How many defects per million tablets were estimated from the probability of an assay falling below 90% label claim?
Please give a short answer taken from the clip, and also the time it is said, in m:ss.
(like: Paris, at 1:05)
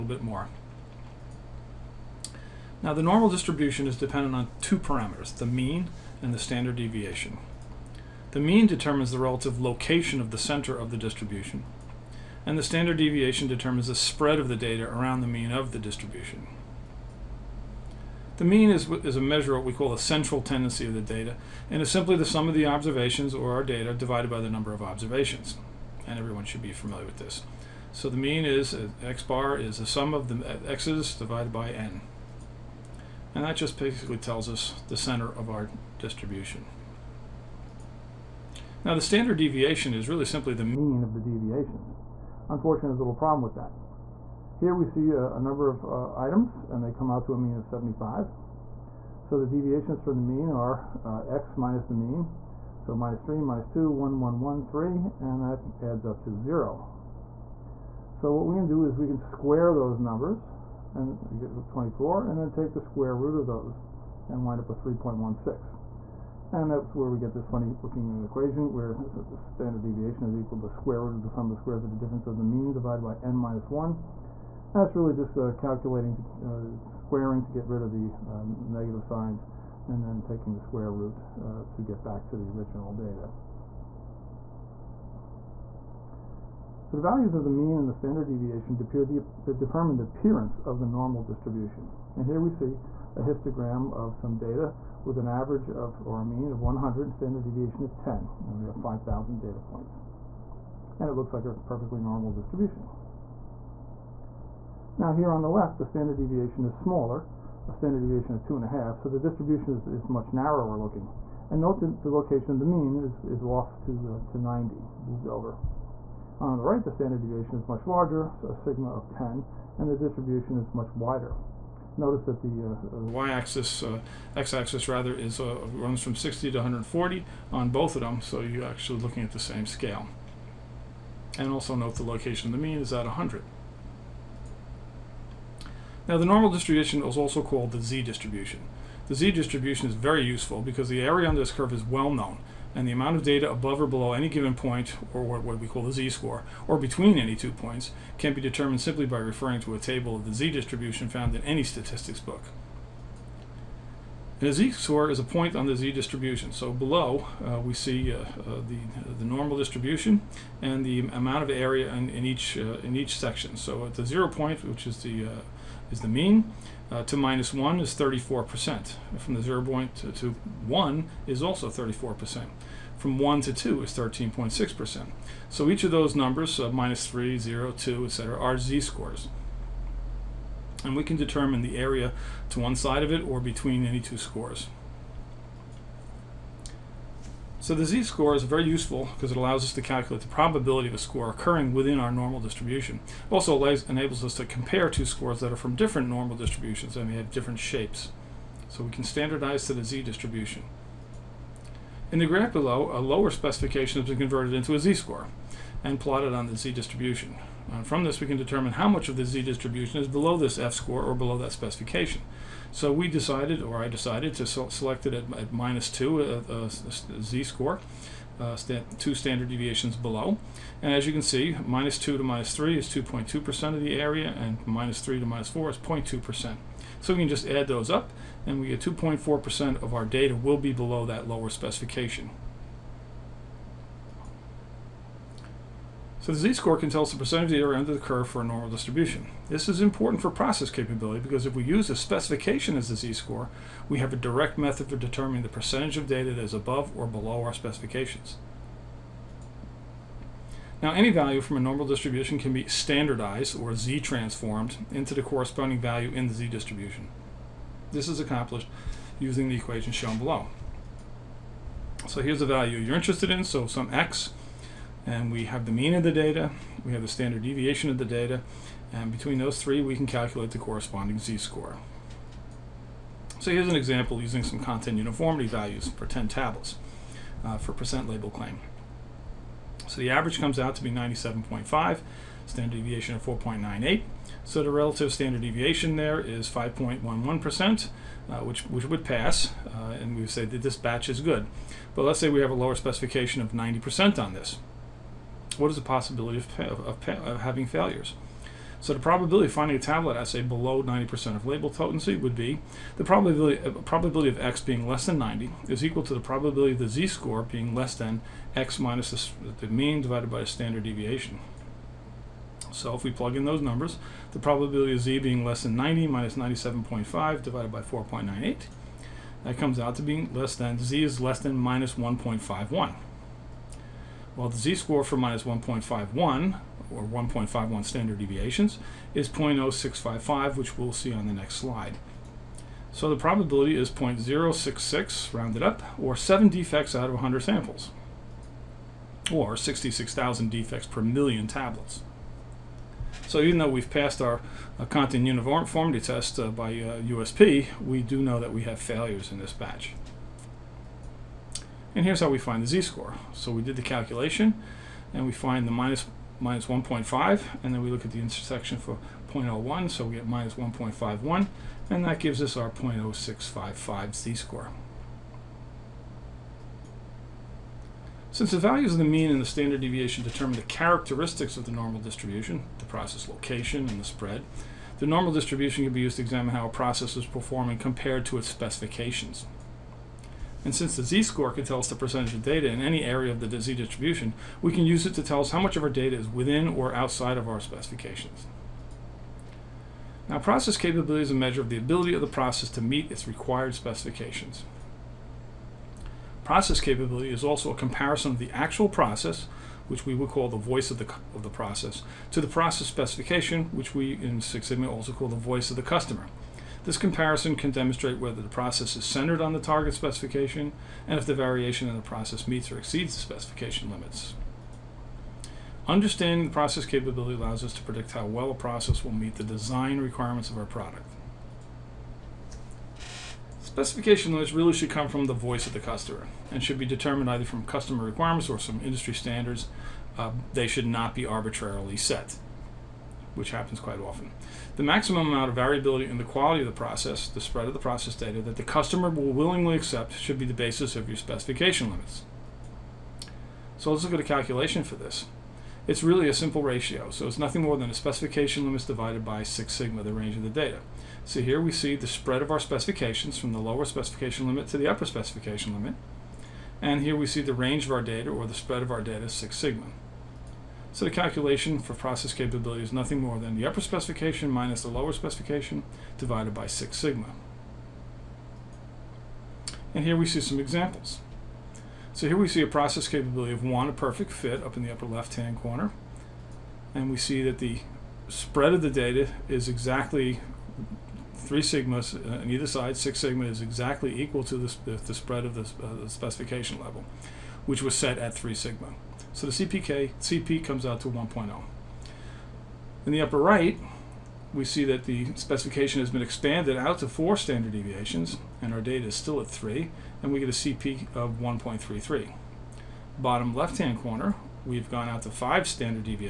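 66,000, at 5:39.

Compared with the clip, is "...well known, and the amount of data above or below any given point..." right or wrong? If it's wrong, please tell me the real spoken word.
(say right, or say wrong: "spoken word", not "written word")
right.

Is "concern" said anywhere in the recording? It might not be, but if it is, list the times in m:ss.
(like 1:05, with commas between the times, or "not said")
not said.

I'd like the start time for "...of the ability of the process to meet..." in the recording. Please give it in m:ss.
6:31.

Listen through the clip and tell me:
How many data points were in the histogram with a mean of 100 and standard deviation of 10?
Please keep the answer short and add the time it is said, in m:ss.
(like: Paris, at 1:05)
5,000, at 1:38.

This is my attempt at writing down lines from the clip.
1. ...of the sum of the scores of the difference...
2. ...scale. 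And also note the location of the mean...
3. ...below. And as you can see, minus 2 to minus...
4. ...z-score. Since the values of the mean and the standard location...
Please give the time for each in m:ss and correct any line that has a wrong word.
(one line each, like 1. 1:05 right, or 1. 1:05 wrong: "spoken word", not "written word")
1. 1:11 wrong: "squares", not "scores"
2. 2:09 right
3. 3:39 right
4. 6:04 wrong: "deviation", not "location".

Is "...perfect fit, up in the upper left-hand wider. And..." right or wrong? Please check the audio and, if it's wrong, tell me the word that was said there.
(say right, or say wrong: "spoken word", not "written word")
wrong: "corner", not "wider".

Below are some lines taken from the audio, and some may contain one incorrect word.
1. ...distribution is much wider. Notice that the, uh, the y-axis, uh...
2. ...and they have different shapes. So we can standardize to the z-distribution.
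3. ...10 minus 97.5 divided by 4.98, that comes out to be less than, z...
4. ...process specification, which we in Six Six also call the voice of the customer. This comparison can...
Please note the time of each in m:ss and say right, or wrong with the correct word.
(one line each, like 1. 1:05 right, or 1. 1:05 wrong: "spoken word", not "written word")
1. 1:59 right
2. 3:16 right
3. 5:15 wrong: "90", not "10"
4. 6:42 wrong: "Sigma", not "Six".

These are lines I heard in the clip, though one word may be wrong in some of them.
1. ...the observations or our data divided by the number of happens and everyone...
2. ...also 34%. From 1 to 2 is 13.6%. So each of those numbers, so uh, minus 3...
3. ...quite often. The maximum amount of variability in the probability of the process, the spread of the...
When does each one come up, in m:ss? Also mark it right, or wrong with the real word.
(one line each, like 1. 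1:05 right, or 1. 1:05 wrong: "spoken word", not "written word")
1. 0:22 wrong: "observations", not "happens"
2. 2:51 right
3. 7:13 wrong: "quality", not "probability".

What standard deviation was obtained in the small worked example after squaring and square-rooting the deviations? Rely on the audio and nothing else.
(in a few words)
3.16.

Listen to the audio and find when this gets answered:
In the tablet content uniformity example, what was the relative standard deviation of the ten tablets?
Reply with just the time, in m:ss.
4:46.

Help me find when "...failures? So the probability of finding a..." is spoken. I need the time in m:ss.
4:57.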